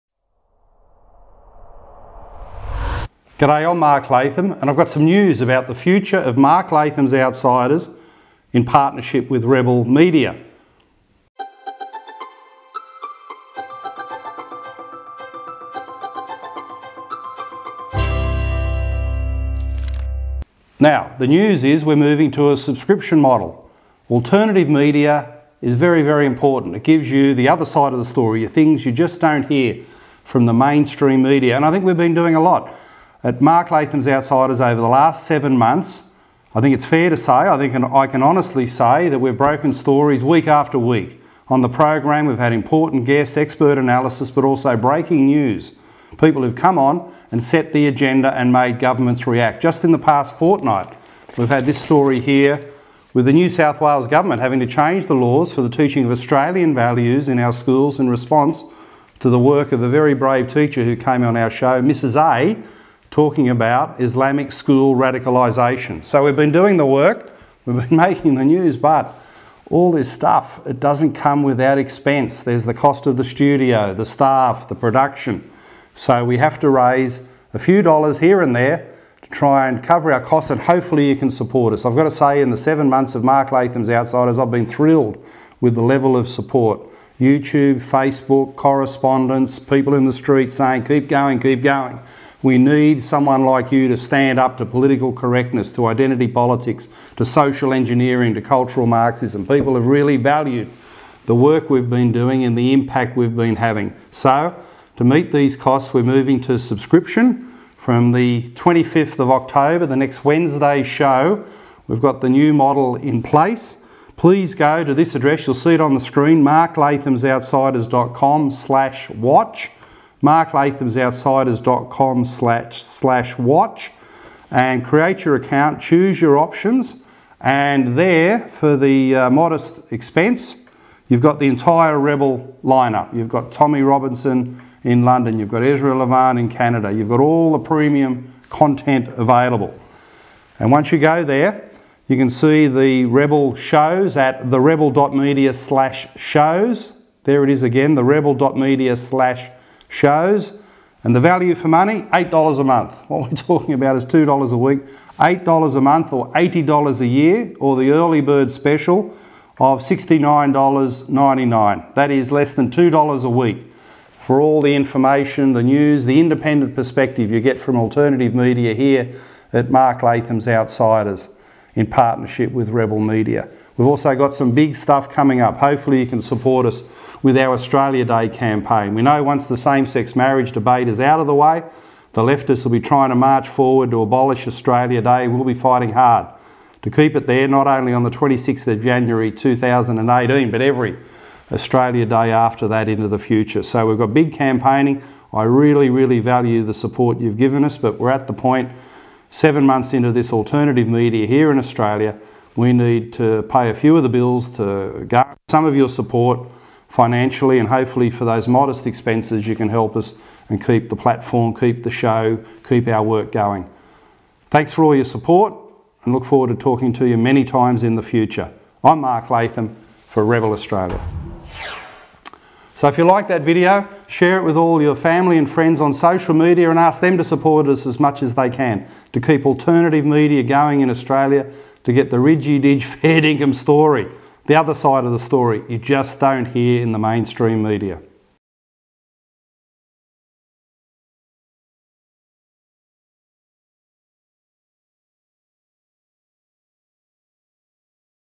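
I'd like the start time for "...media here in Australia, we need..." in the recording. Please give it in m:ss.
3:20.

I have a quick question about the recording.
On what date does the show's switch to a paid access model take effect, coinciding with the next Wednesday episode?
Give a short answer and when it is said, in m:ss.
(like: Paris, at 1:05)
25th of October, at 1:48.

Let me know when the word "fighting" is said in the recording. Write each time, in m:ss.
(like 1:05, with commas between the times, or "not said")
3:05.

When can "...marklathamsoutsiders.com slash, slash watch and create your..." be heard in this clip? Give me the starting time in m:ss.
2:00.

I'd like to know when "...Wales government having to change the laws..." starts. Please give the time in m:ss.
0:53.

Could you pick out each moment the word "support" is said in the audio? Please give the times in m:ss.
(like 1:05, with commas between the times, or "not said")
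1:21, 1:26, 2:56, 3:16, 3:25, 3:35, 3:47.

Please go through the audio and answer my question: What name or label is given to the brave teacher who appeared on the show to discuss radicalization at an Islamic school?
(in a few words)
Mrs A.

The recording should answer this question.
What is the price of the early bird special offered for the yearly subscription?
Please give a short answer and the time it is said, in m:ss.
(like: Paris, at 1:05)
$69.99, at 2:39.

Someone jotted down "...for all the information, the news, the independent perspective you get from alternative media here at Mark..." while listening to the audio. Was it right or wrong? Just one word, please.
right.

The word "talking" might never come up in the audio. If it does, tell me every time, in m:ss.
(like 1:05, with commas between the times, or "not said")
1:03, 2:33, 3:36.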